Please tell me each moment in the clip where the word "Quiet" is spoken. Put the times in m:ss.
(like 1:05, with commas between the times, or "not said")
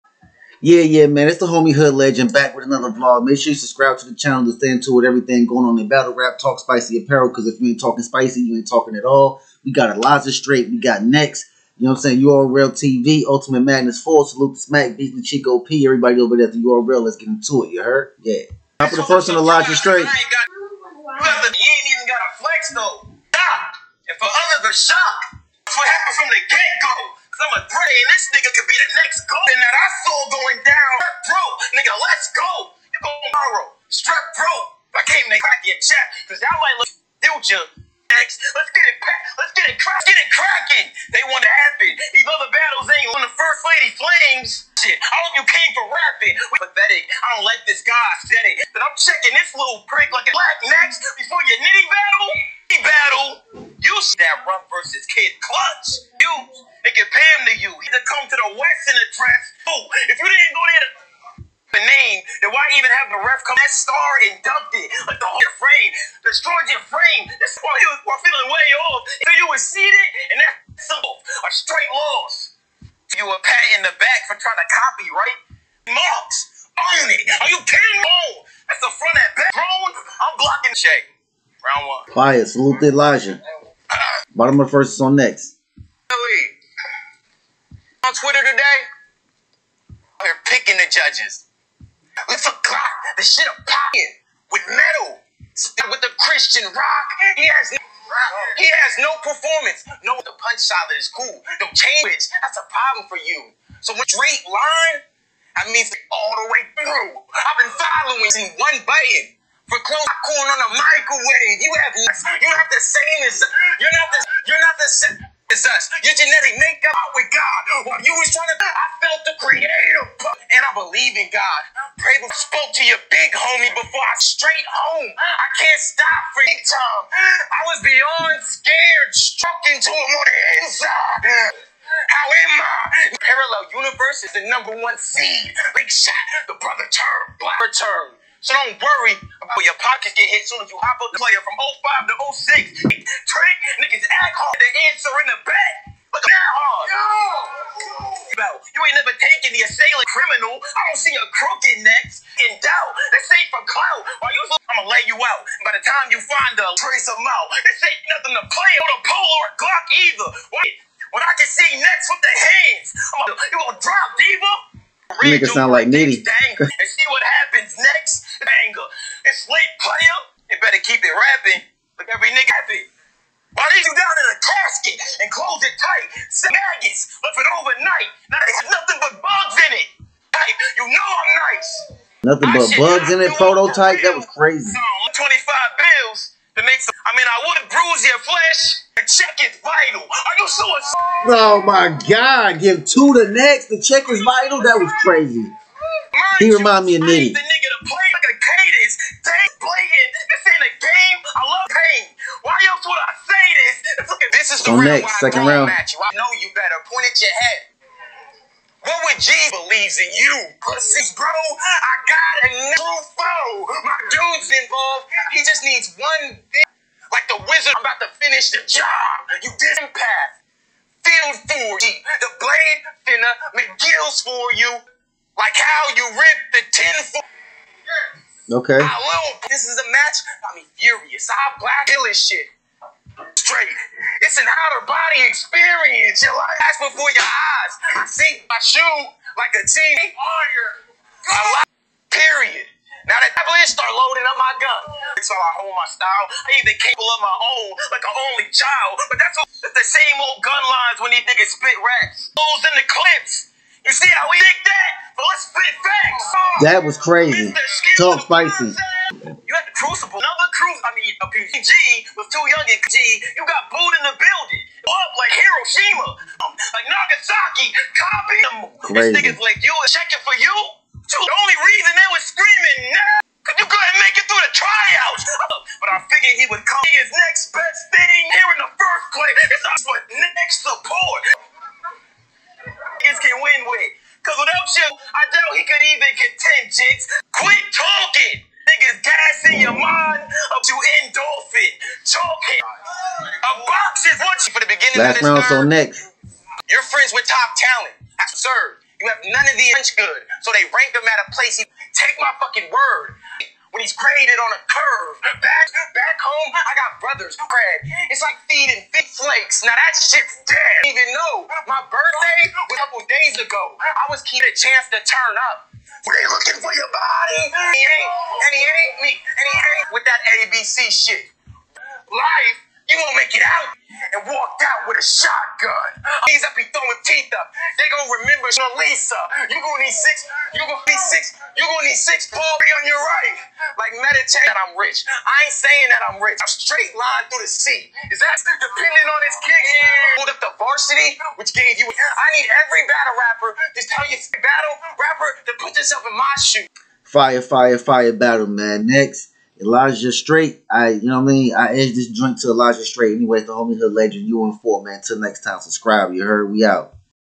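1:22.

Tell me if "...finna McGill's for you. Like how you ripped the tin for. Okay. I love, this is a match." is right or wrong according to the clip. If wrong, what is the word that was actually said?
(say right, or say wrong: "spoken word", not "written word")
right.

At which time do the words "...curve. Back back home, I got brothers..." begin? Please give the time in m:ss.
5:04.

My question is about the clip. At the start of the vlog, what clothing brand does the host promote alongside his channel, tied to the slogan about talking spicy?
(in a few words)
Spicy Apparel.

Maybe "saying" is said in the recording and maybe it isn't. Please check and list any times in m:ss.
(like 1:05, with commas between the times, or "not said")
0:12, 5:35.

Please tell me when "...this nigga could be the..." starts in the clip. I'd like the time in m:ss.
0:28.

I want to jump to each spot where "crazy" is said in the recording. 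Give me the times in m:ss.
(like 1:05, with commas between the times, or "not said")
3:04, 3:15, 4:17.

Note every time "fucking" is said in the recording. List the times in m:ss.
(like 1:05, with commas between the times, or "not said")
4:22, 5:02.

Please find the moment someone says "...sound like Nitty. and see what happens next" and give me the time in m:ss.
2:45.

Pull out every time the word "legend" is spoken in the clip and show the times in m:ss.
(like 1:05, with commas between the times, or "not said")
0:01, 5:53.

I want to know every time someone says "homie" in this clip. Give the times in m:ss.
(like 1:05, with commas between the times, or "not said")
0:01, 2:03, 5:53.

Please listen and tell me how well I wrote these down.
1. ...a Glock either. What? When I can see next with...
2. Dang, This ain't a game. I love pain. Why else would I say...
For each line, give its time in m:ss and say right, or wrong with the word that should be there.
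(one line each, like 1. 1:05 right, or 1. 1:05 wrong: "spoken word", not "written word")
1. 2:39 right
2. 3:19 right.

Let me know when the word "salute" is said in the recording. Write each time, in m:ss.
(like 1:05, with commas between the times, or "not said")
0:14, 1:22.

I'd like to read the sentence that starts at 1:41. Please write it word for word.
No change, that's a problem for you.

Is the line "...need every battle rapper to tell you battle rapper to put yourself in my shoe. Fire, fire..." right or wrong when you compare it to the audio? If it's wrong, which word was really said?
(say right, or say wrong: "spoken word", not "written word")
right.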